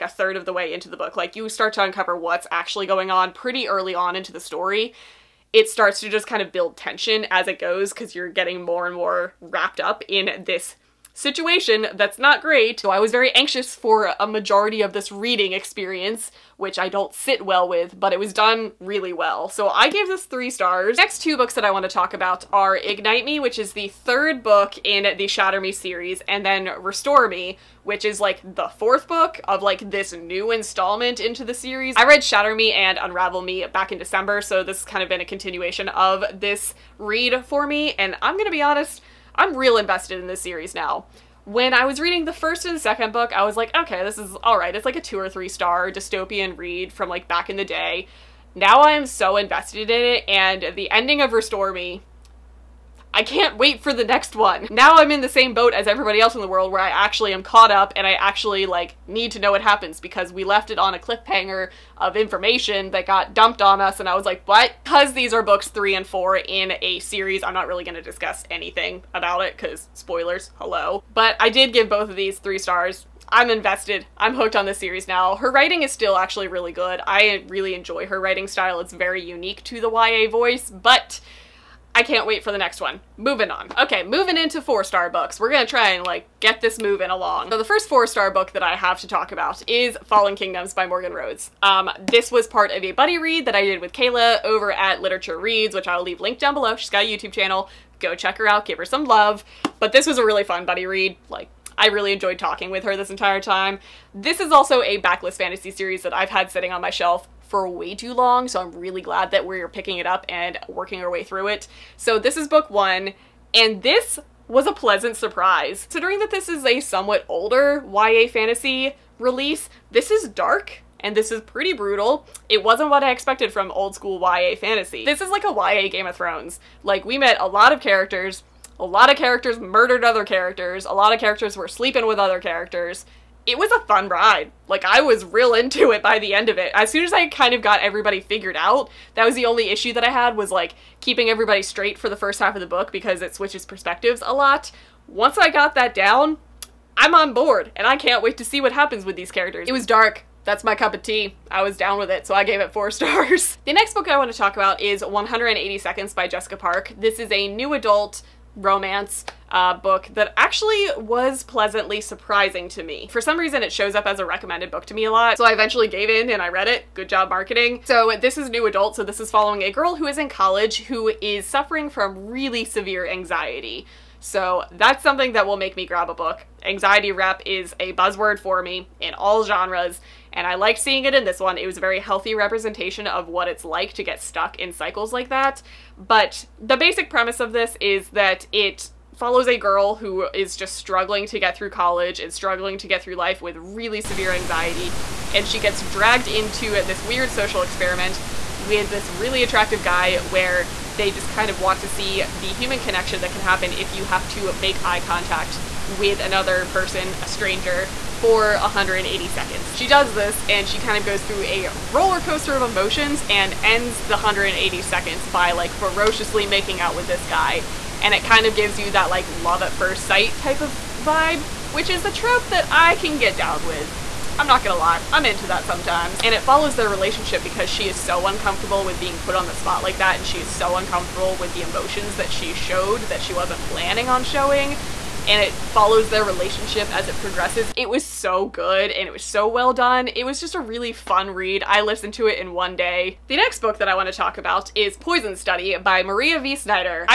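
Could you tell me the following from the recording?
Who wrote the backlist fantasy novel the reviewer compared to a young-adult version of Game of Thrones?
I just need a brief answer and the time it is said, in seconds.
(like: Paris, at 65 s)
Morgan Rhodes, at 90 s.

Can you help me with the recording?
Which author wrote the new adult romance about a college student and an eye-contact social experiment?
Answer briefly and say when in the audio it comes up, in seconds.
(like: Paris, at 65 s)
Jessica Park, at 156 s.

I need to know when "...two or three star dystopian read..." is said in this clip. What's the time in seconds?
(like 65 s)
44 s.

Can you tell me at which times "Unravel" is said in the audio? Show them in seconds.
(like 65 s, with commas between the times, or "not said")
33 s.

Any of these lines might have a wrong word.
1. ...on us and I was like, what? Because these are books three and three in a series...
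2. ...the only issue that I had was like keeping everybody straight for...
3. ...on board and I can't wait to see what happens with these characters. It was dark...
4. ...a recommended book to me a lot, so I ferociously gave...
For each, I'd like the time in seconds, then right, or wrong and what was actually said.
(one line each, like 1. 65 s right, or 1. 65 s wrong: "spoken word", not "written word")
1. 63 s wrong: "four", not "three"
2. 139 s right
3. 147 s right
4. 164 s wrong: "eventually", not "ferociously".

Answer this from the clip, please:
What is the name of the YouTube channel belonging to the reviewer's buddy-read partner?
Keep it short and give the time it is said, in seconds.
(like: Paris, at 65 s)
Literature Reads, at 95 s.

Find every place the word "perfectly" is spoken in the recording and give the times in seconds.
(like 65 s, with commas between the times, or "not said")
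not said.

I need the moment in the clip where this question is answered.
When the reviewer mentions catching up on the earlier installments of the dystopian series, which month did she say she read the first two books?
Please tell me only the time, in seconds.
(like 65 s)
33 s.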